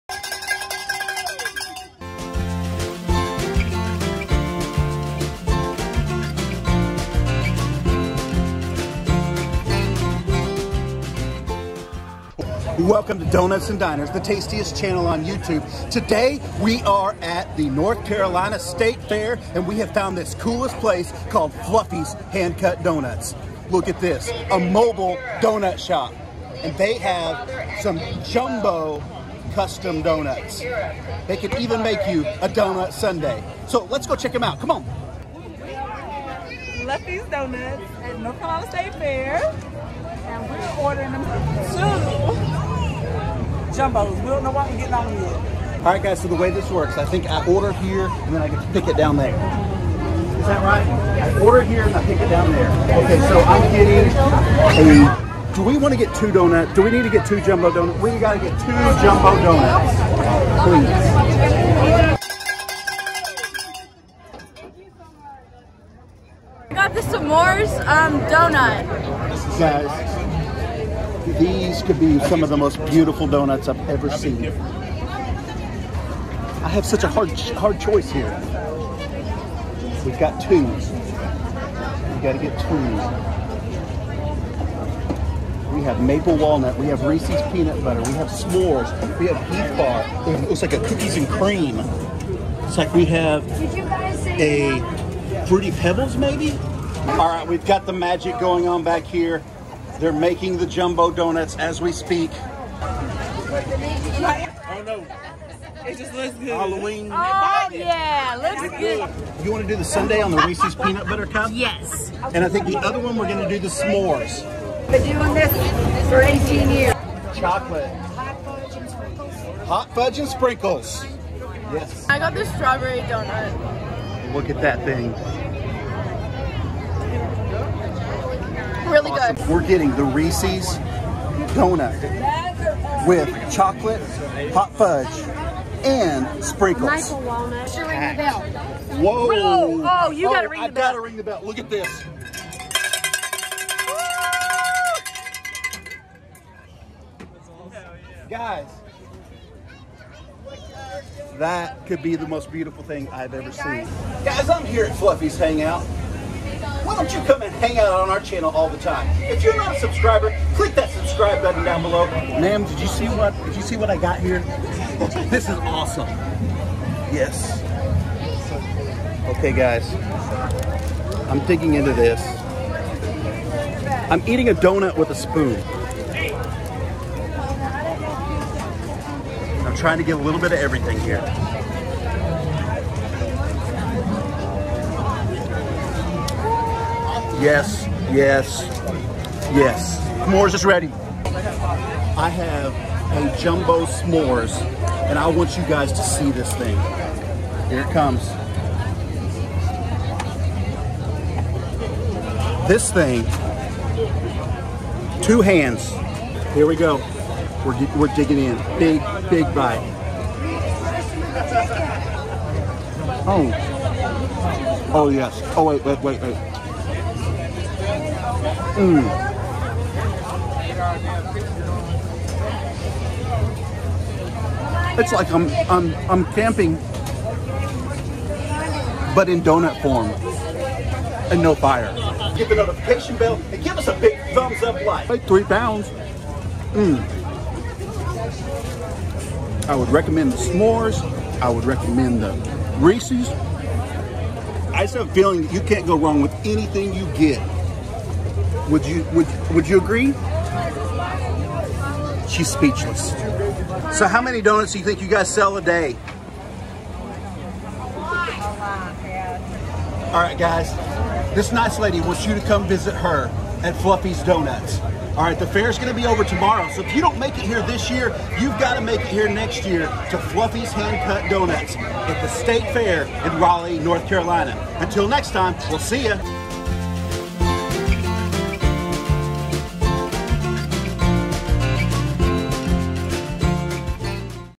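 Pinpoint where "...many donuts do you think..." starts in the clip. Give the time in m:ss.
4:14.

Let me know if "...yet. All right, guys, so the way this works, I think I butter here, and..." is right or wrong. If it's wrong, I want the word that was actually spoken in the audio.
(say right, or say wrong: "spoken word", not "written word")
wrong: "order", not "butter".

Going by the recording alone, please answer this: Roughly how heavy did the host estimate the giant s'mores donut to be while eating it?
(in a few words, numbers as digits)
3 pounds.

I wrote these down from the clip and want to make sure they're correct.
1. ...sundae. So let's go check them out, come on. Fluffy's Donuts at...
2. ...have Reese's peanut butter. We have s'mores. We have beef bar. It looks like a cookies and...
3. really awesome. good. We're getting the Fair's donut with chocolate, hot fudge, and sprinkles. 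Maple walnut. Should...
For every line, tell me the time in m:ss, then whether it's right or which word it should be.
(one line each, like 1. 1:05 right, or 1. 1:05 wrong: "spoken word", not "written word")
1. 0:32 right
2. 1:26 right
3. 2:08 wrong: "Reese", not "Fair".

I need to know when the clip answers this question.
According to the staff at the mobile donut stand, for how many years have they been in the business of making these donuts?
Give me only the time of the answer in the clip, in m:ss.
1:56.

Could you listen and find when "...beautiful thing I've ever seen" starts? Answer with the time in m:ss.
2:32.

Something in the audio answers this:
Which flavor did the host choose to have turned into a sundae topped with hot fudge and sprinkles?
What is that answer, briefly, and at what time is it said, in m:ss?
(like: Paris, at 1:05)
Reese's peanut butter cup, at 1:50.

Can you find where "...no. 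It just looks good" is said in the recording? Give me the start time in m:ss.
1:44.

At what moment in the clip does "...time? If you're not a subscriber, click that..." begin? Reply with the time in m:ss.
2:38.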